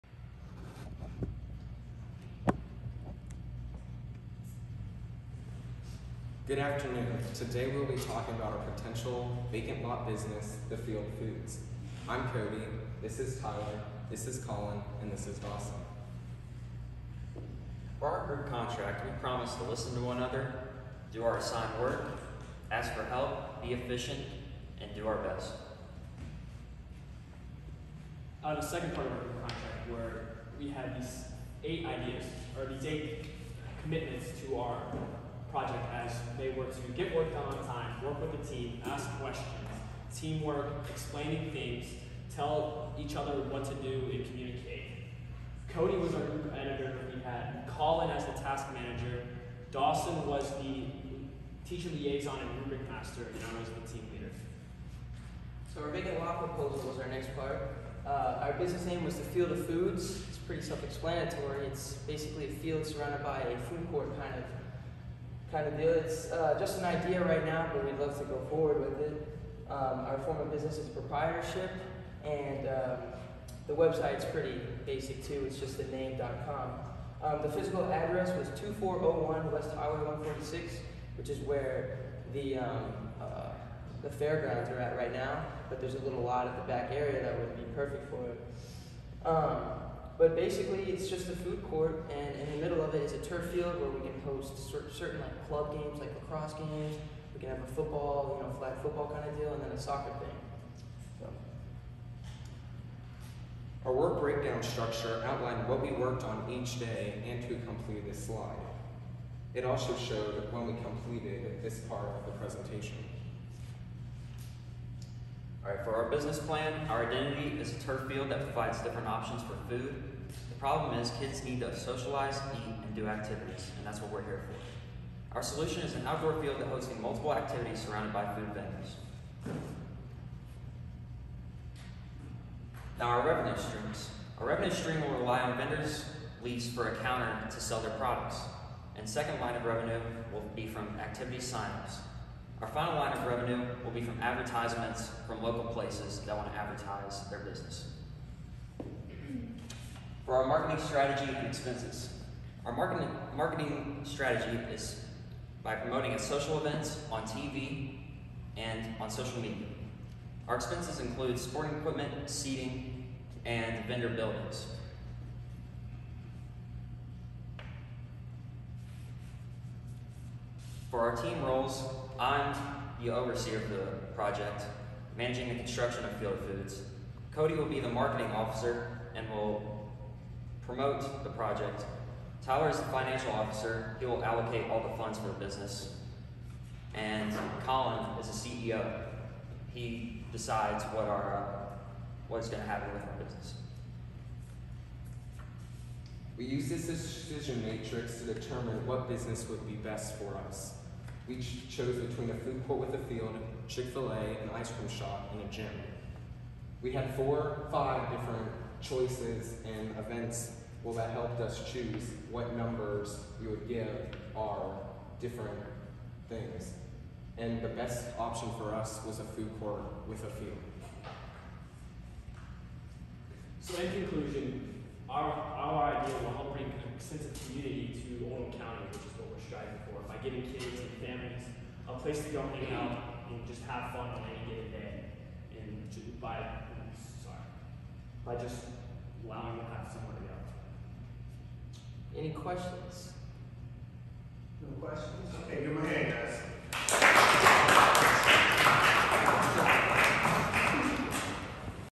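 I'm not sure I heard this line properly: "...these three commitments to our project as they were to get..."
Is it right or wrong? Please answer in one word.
wrong.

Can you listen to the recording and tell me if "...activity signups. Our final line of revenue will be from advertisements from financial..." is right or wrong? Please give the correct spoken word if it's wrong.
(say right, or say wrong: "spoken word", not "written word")
wrong: "local", not "financial".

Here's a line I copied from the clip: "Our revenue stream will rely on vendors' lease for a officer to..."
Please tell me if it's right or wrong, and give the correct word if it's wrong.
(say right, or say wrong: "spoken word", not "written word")
wrong: "counter", not "officer".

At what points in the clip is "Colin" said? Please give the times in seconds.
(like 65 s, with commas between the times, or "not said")
14 s, 47 s, 187 s.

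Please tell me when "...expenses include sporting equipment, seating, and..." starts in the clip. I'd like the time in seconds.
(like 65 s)
160 s.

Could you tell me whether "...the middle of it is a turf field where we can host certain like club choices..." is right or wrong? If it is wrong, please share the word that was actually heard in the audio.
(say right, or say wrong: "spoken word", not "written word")
wrong: "games", not "choices".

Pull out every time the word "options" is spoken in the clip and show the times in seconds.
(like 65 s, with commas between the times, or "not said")
119 s, 218 s.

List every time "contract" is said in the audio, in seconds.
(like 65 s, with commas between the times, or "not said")
18 s, 29 s.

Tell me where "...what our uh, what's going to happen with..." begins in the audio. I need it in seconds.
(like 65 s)
190 s.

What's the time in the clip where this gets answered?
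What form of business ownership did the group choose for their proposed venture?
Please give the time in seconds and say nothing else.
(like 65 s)
70 s.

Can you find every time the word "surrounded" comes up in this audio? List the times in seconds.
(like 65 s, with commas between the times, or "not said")
62 s, 127 s.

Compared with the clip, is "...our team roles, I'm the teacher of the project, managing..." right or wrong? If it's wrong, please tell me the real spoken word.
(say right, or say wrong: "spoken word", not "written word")
wrong: "overseer", not "teacher".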